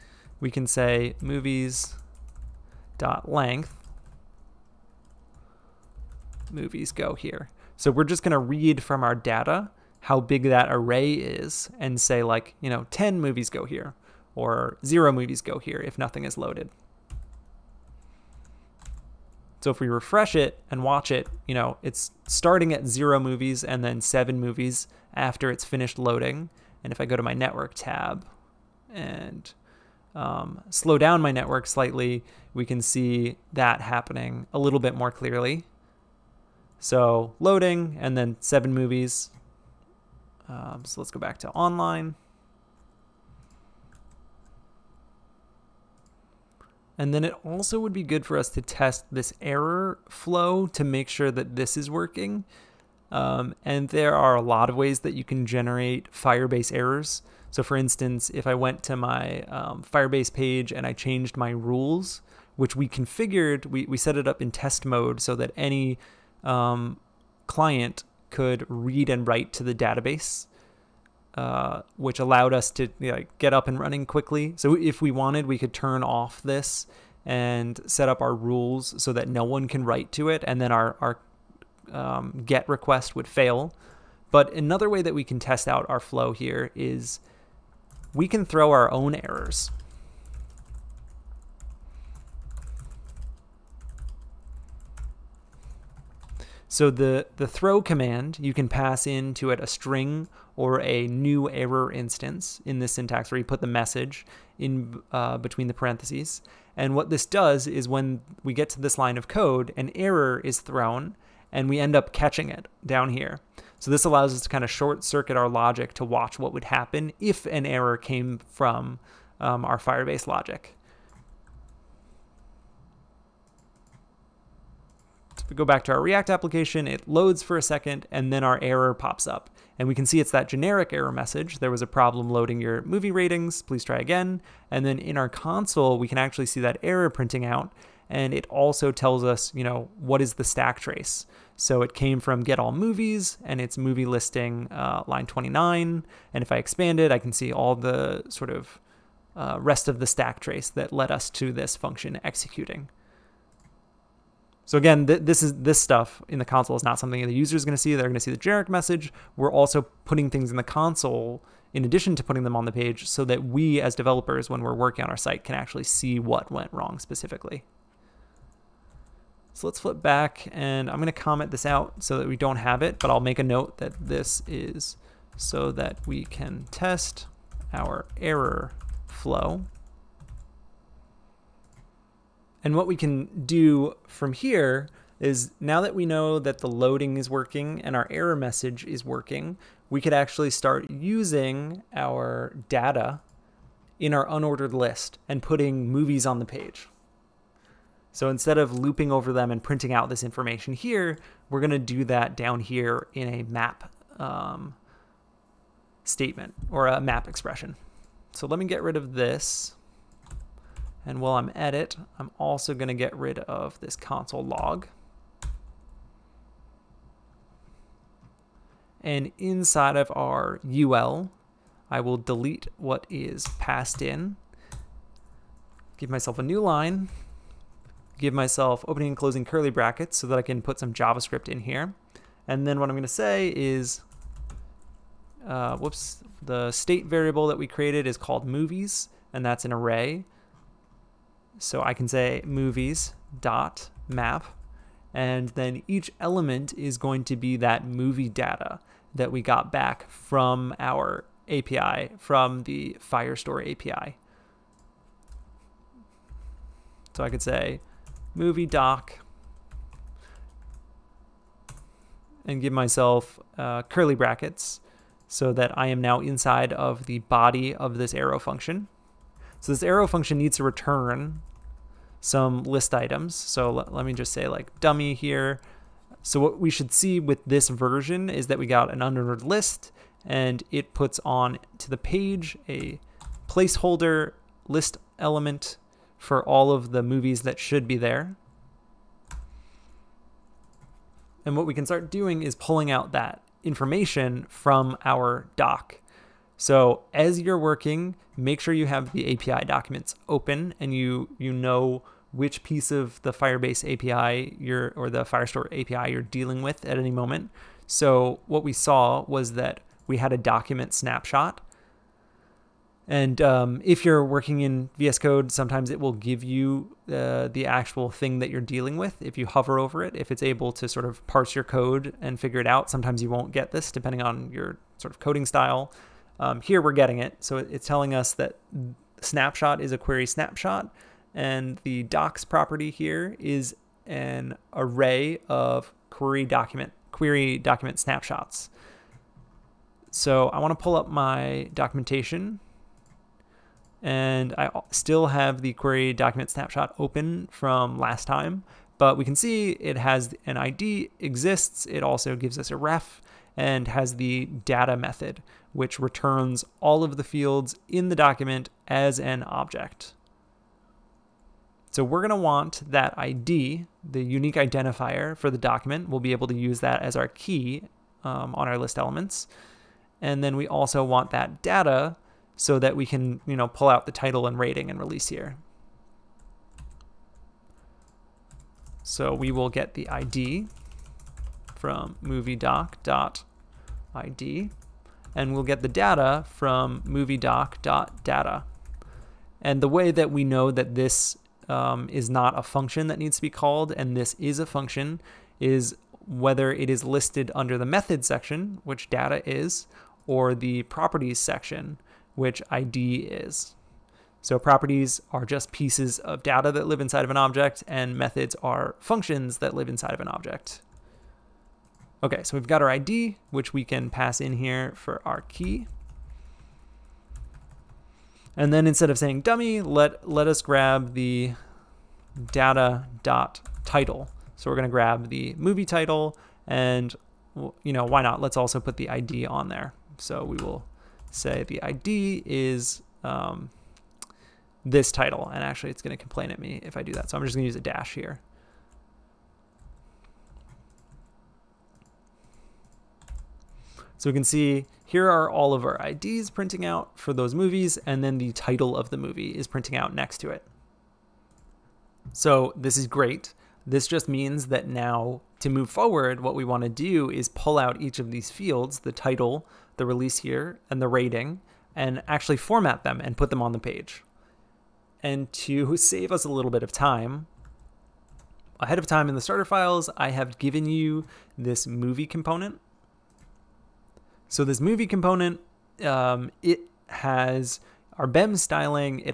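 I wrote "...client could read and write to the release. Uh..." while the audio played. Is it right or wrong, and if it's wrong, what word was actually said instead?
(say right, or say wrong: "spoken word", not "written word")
wrong: "database", not "release".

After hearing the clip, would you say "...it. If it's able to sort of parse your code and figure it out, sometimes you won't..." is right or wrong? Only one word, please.
right.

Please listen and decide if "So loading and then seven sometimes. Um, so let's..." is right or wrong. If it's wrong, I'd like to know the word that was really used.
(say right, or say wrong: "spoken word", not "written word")
wrong: "movies", not "sometimes".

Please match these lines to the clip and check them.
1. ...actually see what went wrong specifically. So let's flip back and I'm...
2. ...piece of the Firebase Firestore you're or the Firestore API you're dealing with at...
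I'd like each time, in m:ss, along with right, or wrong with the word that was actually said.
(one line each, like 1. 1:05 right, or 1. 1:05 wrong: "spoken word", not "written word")
1. 2:45 right
2. 5:02 wrong: "API", not "Firestore".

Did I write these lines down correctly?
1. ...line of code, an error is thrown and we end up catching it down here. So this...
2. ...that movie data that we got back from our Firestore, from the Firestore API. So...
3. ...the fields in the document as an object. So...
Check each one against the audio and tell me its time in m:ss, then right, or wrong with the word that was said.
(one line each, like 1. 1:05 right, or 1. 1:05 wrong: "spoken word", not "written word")
1. 1:48 right
2. 4:07 wrong: "API", not "Firestore"
3. 5:57 right.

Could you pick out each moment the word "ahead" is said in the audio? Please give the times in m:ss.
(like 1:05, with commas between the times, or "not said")
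7:48.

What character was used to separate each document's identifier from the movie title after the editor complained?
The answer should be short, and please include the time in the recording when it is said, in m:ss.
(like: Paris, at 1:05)
dash, at 7:17.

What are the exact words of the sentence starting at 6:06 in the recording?
We'll be able to use that as our key um, on our list elements.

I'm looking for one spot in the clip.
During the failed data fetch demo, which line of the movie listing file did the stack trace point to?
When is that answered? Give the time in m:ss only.
2:25.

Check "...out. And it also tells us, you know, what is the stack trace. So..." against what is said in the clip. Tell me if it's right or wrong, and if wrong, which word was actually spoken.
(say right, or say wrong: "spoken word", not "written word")
right.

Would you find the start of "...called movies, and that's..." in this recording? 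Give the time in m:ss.
3:58.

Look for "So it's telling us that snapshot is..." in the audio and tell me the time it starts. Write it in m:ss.
5:27.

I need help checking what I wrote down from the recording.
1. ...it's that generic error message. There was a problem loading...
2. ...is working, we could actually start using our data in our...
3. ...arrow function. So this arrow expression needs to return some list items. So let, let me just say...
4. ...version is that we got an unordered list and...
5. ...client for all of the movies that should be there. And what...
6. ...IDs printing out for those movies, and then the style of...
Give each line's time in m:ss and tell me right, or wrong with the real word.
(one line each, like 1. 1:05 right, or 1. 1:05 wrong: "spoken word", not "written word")
1. 2:10 right
2. 3:08 right
3. 4:28 wrong: "function", not "expression"
4. 4:37 right
5. 4:45 wrong: "element", not "client"
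6. 7:26 wrong: "title", not "style".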